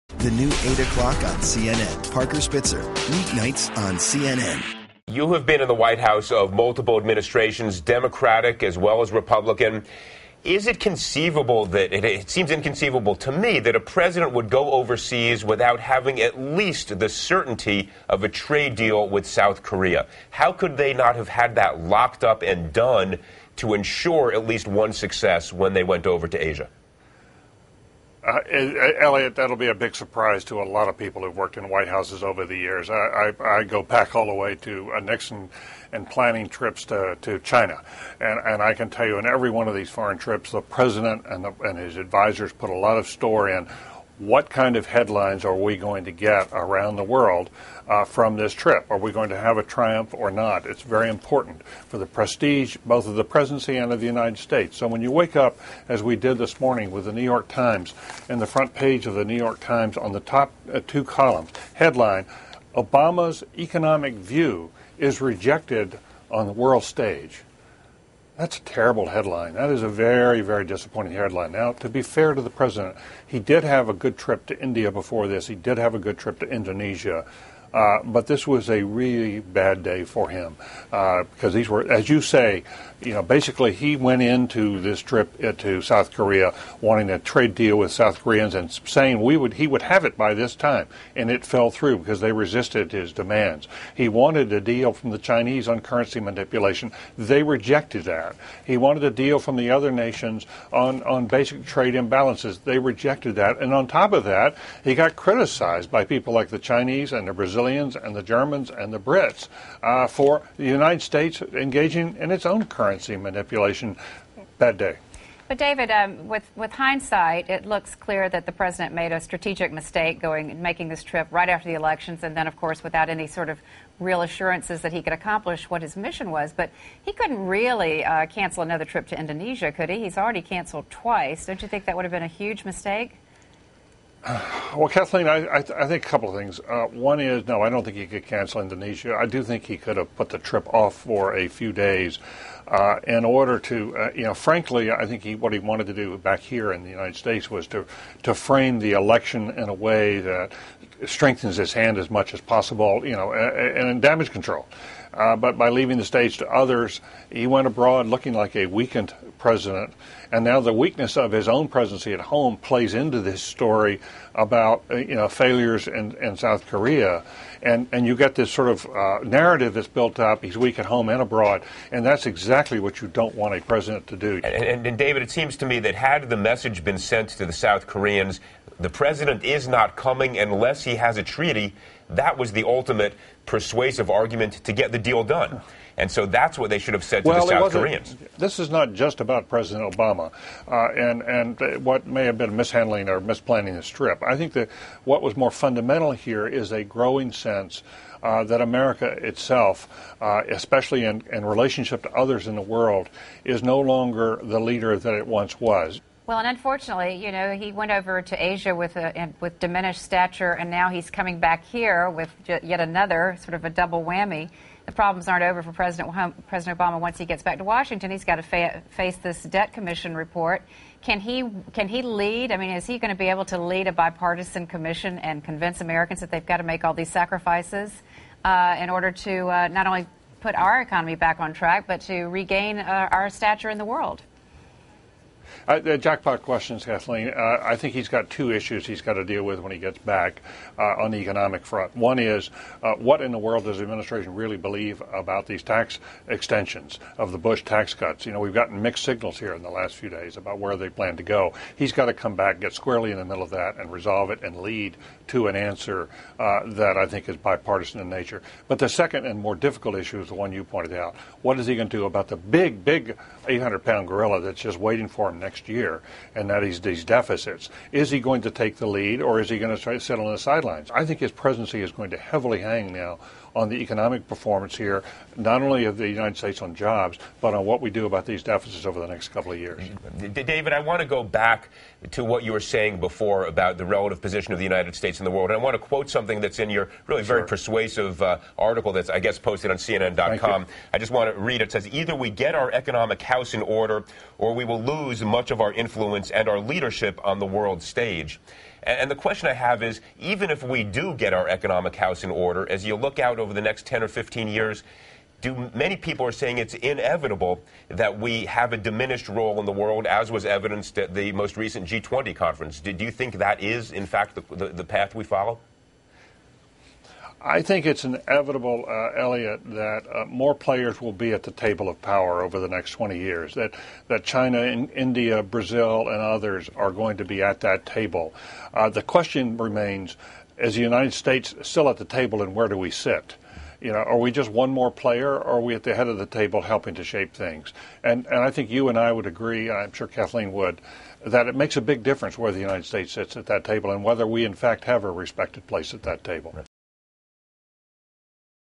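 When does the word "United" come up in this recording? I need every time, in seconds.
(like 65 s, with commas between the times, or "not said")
54 s, 110 s, 146 s, 276 s, 284 s, 330 s, 342 s.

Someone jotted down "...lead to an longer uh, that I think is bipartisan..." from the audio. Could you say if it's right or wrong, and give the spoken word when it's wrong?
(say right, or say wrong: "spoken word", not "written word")
wrong: "answer", not "longer".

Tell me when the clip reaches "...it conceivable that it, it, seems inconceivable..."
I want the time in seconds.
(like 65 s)
10 s.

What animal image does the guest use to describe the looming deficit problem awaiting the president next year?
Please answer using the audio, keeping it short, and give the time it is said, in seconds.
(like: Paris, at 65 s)
800 pound gorilla, at 263 s.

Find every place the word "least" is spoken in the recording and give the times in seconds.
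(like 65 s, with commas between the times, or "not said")
16 s, 24 s.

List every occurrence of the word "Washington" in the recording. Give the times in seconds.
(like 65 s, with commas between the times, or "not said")
217 s.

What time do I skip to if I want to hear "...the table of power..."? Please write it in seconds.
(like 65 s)
321 s.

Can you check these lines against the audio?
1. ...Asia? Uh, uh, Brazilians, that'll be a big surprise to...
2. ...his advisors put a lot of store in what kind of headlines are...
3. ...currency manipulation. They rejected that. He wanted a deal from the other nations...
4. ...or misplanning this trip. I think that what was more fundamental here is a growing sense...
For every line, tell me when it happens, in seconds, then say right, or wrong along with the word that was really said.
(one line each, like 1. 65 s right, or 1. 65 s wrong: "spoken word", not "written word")
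1. 26 s wrong: "Eliot", not "Brazilians"
2. 41 s right
3. 95 s right
4. 193 s right.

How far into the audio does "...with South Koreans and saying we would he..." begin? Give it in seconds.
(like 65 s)
87 s.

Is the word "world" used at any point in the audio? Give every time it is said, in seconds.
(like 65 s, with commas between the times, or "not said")
47 s, 66 s, 202 s, 233 s, 243 s, 285 s, 297 s, 309 s.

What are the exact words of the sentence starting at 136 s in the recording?
Uh, one is no, I don't think he could cancel Indonesia.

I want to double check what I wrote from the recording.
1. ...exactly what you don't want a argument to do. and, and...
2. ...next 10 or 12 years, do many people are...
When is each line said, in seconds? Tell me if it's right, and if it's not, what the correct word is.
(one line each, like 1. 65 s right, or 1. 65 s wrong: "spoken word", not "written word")
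1. 172 s wrong: "president", not "argument"
2. 303 s wrong: "15", not "12".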